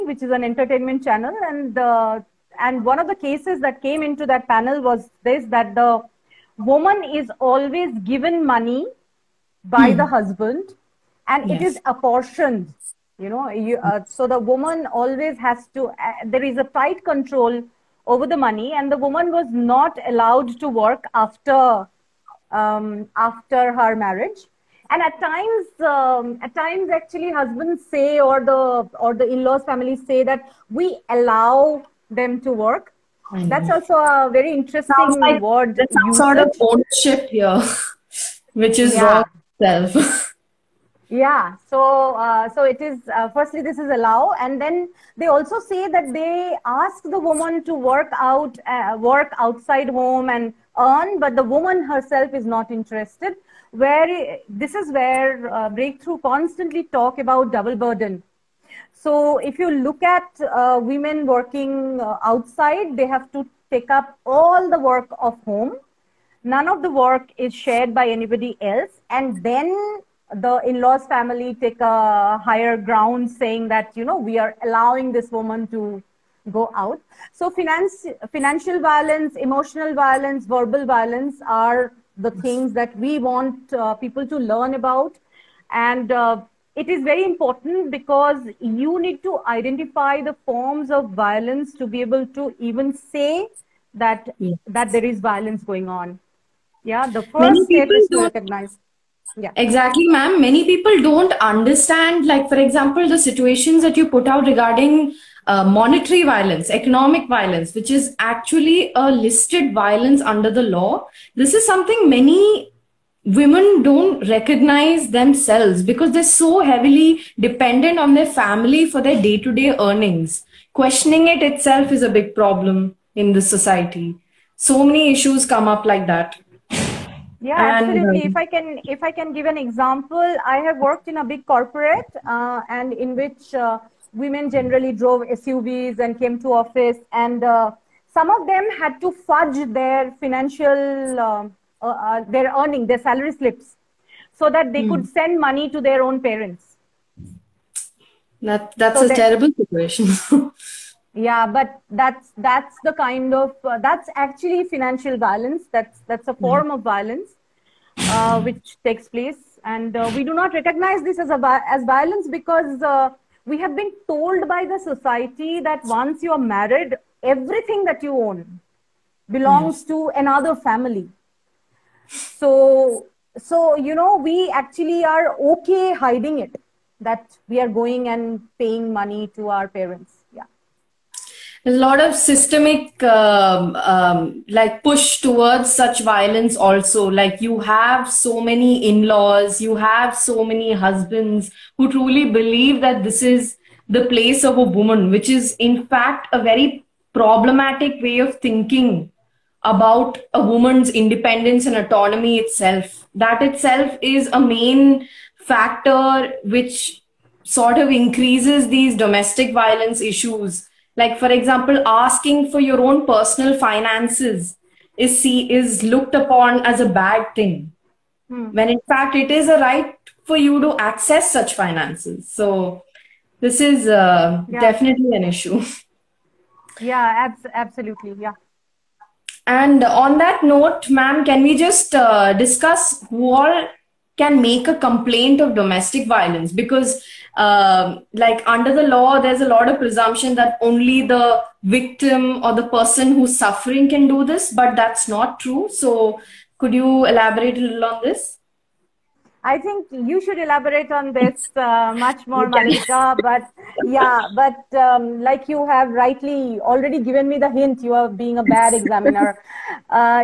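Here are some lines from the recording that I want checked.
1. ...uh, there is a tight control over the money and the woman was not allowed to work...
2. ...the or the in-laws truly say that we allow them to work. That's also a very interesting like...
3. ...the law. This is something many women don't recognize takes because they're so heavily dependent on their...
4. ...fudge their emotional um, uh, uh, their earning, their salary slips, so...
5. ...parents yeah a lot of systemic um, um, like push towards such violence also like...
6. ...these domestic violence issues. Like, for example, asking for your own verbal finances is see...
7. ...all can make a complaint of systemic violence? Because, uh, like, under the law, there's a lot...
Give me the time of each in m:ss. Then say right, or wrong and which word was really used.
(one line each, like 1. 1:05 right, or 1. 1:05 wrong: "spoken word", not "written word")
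1. 0:15 right
2. 0:28 wrong: "family", not "truly"
3. 1:50 wrong: "themselves", not "takes"
4. 2:19 wrong: "financial", not "emotional"
5. 2:59 right
6. 3:28 wrong: "personal", not "verbal"
7. 3:53 wrong: "domestic", not "systemic".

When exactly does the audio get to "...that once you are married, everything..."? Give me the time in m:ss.
2:45.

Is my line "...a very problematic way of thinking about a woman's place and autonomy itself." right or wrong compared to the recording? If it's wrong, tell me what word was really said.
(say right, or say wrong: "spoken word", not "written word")
wrong: "independence", not "place".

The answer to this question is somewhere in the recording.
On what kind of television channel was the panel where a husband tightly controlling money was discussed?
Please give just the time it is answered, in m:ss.
0:00.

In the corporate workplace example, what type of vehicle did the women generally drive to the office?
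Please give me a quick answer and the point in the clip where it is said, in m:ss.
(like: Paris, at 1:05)
SUVs, at 2:15.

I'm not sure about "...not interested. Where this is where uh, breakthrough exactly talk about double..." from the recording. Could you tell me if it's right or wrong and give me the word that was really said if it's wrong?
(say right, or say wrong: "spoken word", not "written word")
wrong: "constantly", not "exactly".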